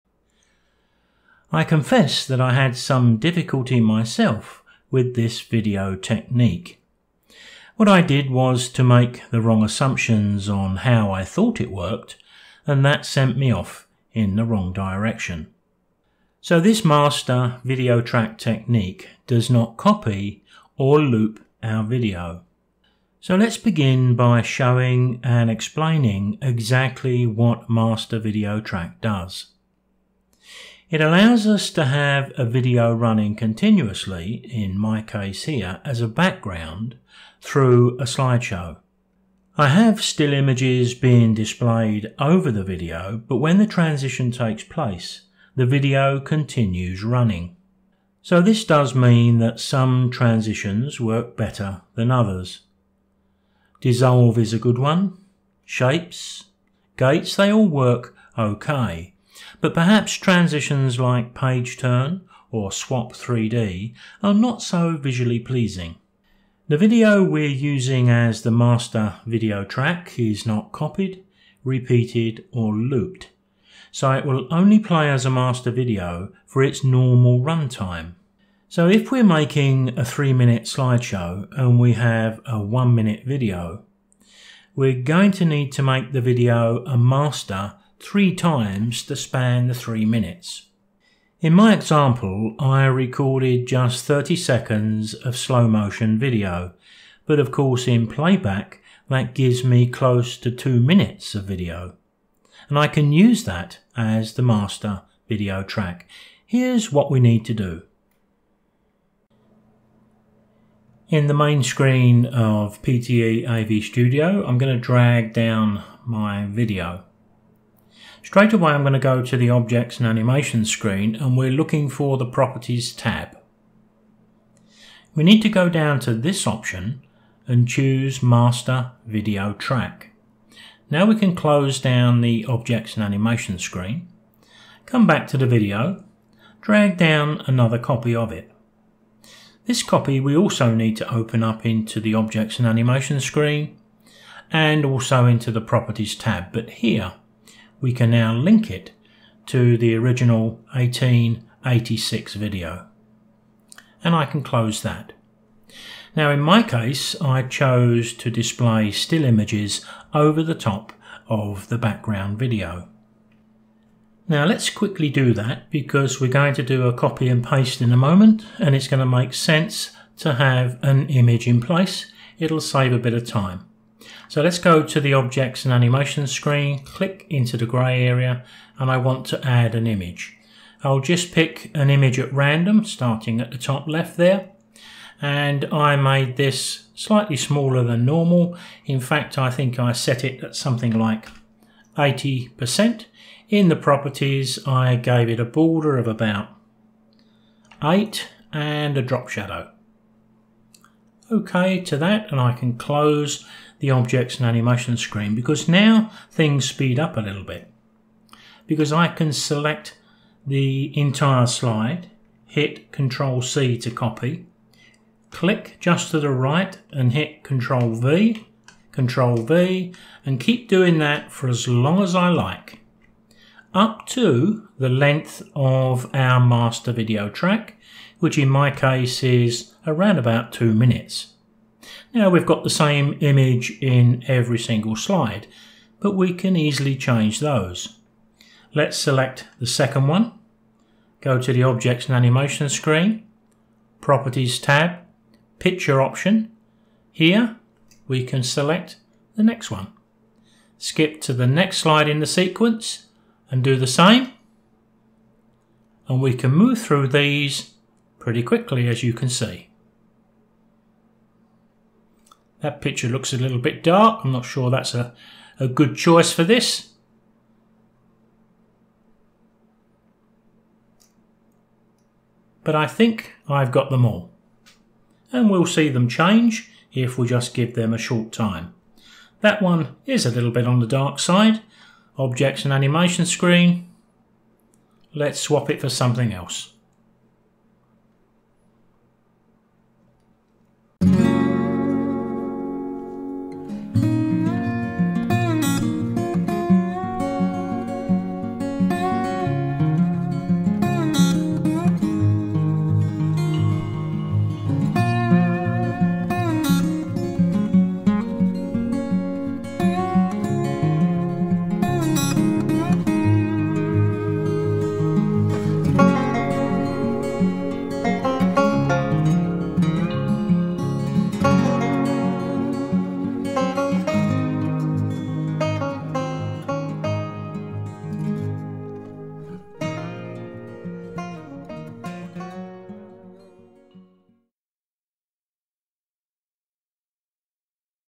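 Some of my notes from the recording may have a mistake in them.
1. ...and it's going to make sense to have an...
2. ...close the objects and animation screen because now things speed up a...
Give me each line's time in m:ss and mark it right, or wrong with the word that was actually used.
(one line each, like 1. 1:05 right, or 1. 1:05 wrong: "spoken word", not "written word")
1. 2:48 right
2. 3:22 right.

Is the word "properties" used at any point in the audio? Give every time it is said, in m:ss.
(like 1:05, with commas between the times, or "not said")
2:02, 2:25, 3:13, 4:04.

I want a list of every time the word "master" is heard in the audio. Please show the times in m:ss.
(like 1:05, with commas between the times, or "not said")
0:16, 0:27, 1:08, 1:15, 1:26, 1:44, 2:08, 3:46.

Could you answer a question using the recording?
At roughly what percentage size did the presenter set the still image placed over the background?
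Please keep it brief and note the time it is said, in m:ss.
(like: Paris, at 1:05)
80%, at 3:11.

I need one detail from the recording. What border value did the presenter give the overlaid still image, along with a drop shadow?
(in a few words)
8.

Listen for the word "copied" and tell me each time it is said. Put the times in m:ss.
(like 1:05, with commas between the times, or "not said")
1:10.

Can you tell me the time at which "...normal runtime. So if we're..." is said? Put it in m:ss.
1:16.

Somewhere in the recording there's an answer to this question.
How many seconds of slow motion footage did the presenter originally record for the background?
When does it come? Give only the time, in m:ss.
1:34.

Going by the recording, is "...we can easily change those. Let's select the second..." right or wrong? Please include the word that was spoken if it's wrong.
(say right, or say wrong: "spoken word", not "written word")
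right.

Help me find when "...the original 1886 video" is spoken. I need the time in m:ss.
2:29.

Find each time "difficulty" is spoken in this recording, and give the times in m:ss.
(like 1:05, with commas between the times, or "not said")
0:03.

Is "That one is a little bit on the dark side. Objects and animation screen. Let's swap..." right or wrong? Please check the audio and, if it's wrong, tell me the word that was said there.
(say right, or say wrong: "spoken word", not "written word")
right.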